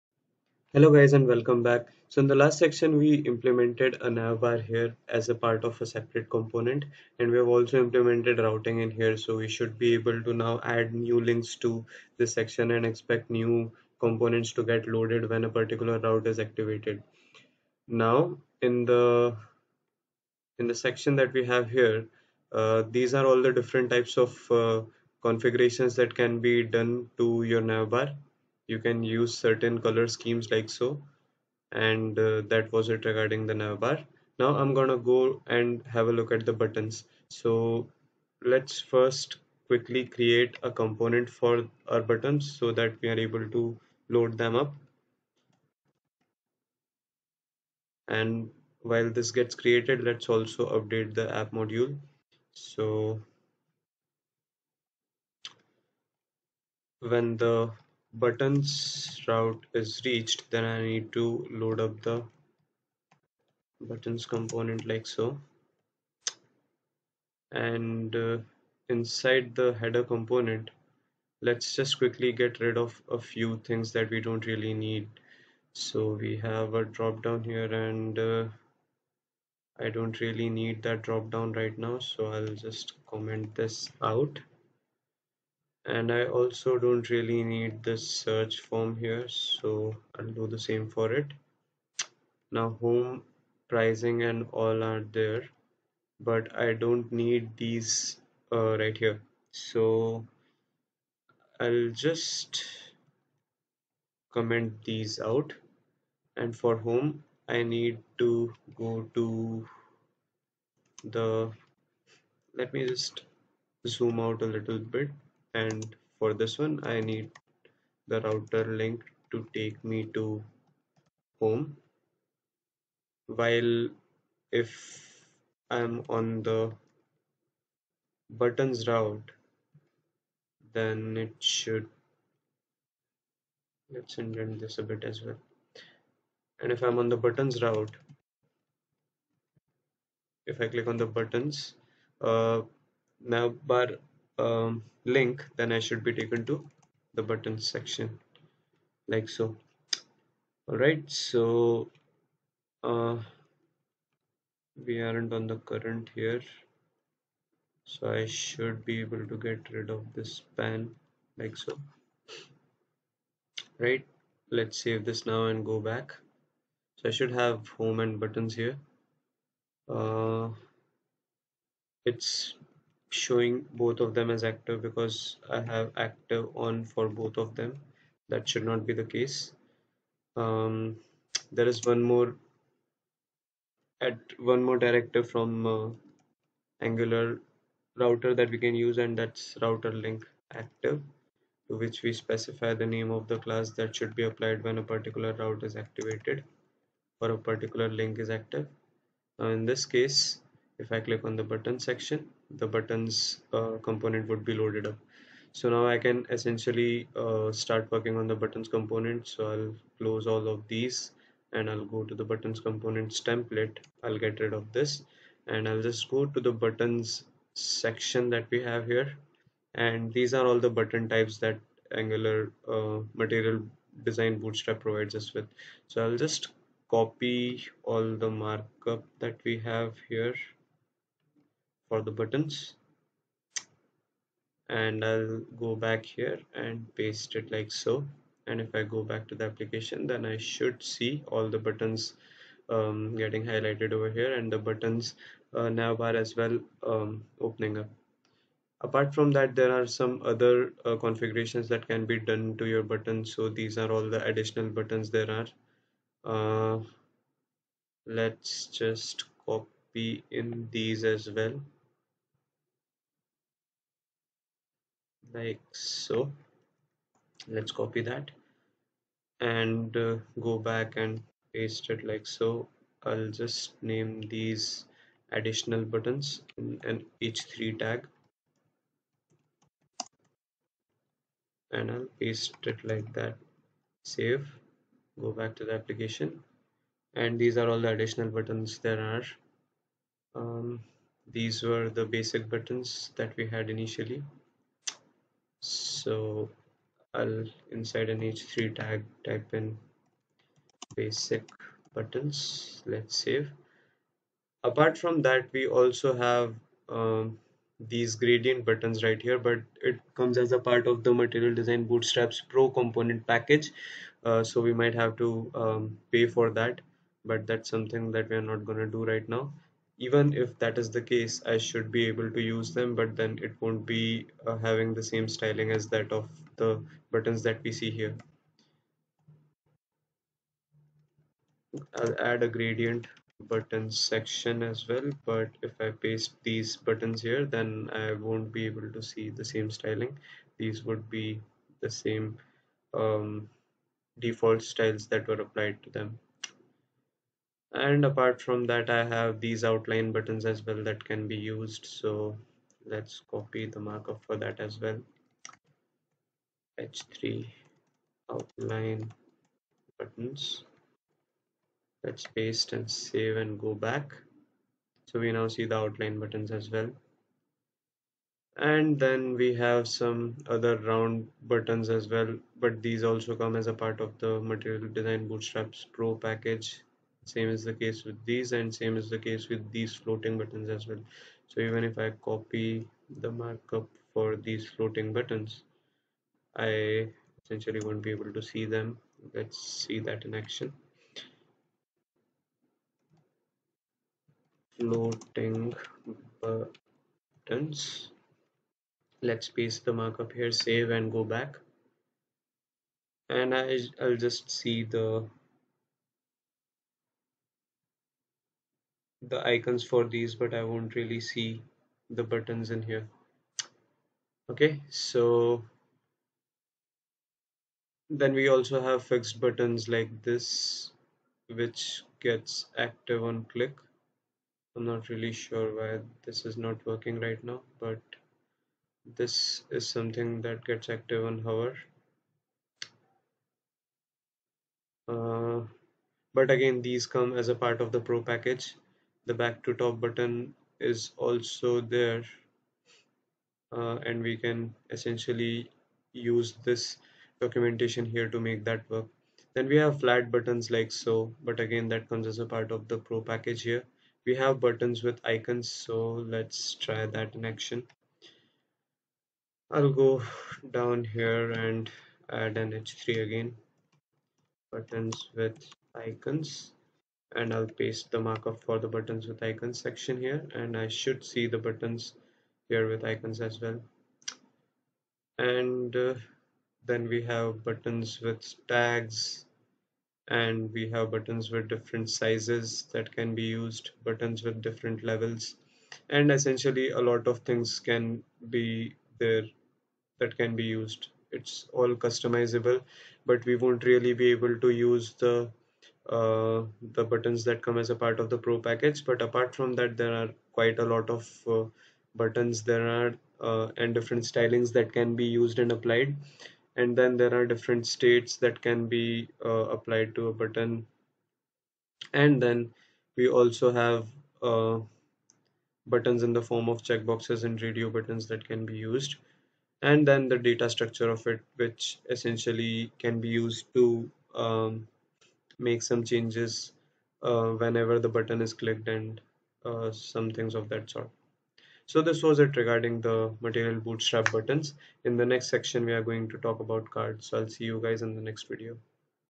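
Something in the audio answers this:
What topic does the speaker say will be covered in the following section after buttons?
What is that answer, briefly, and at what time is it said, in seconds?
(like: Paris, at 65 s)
cards, at 536 s.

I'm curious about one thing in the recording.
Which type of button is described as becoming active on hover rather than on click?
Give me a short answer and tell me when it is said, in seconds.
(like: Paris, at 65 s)
fixed buttons, at 419 s.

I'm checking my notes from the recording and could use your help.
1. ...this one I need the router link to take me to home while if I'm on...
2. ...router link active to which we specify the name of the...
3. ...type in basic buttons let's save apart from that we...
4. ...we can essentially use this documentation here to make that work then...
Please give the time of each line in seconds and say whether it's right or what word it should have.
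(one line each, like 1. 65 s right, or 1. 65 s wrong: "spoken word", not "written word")
1. 116 s right
2. 189 s right
3. 299 s right
4. 444 s right.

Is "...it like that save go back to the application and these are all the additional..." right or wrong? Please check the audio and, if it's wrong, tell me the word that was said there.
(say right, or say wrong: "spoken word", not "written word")
right.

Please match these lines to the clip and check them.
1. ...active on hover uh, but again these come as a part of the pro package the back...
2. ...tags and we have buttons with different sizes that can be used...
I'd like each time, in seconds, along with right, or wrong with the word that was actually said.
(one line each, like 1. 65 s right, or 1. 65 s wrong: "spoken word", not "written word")
1. 430 s right
2. 478 s right.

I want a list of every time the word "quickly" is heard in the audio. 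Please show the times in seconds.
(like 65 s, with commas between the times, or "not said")
39 s, 71 s.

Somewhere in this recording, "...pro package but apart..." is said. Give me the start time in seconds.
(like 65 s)
498 s.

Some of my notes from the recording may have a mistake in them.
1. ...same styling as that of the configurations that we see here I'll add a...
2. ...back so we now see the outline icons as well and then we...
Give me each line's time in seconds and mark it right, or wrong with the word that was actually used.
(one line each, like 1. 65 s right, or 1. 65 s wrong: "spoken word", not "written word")
1. 325 s wrong: "buttons", not "configurations"
2. 363 s wrong: "buttons", not "icons".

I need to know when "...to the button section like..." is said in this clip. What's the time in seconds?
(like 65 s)
146 s.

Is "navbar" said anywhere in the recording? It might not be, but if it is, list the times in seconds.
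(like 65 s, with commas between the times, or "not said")
4 s, 27 s, 33 s, 245 s.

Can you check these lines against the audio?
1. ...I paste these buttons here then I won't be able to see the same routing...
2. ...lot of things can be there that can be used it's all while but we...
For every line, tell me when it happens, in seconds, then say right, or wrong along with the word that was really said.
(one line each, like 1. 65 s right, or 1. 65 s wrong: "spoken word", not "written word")
1. 335 s wrong: "styling", not "routing"
2. 486 s wrong: "customizable", not "while".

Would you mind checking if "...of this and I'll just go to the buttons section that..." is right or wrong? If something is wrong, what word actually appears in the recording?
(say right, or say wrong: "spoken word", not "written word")
right.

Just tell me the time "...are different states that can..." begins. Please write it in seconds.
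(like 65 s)
507 s.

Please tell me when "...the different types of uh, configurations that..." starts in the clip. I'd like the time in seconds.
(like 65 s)
23 s.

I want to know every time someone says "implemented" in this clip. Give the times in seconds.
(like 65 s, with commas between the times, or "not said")
3 s, 7 s.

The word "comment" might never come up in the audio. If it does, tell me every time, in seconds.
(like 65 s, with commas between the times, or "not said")
83 s, 104 s.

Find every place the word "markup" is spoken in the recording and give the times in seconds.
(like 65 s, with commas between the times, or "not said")
228 s, 353 s, 383 s, 399 s, 468 s.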